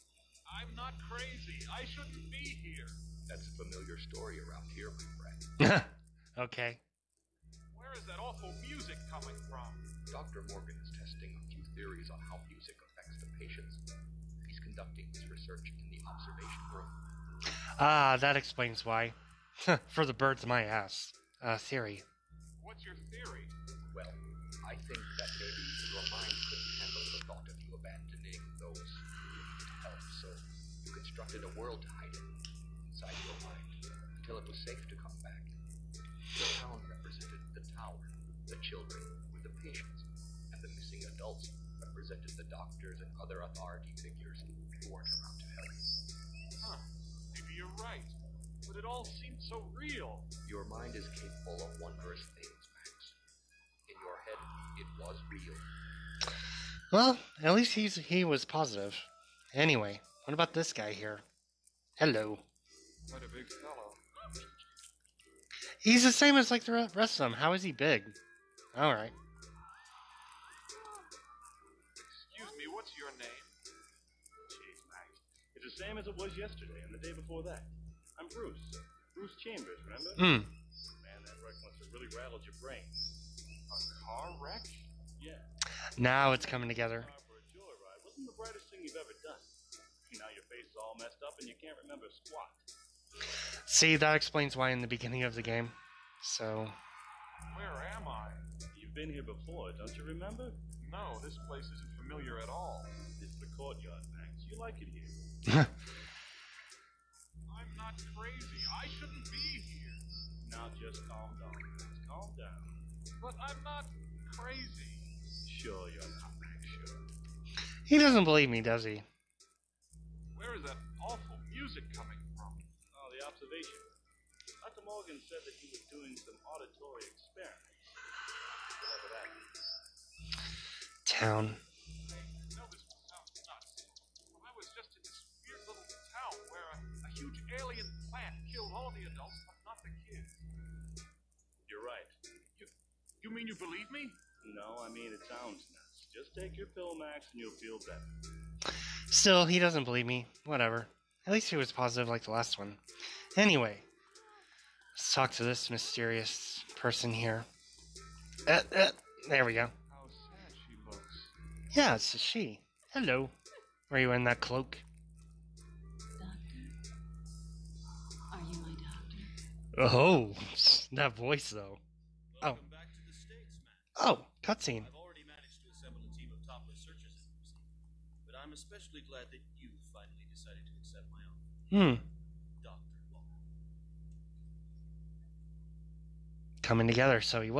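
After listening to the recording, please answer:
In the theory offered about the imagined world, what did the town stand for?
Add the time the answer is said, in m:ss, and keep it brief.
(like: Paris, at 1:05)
The tower, at 0:36.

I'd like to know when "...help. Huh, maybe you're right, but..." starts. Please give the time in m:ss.
0:45.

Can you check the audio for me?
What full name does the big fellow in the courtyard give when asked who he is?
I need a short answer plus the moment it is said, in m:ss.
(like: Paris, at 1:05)
Bruce Chambers, at 1:19.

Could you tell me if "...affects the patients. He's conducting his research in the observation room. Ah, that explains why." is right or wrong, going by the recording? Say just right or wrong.
right.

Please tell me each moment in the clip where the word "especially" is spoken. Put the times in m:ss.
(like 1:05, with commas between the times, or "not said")
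2:58.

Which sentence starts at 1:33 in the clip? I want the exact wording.
See, that explains why in the beginning of the game.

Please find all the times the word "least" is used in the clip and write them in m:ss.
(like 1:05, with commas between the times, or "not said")
0:57, 2:31.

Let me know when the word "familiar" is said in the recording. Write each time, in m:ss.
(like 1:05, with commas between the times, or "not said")
0:03, 1:42.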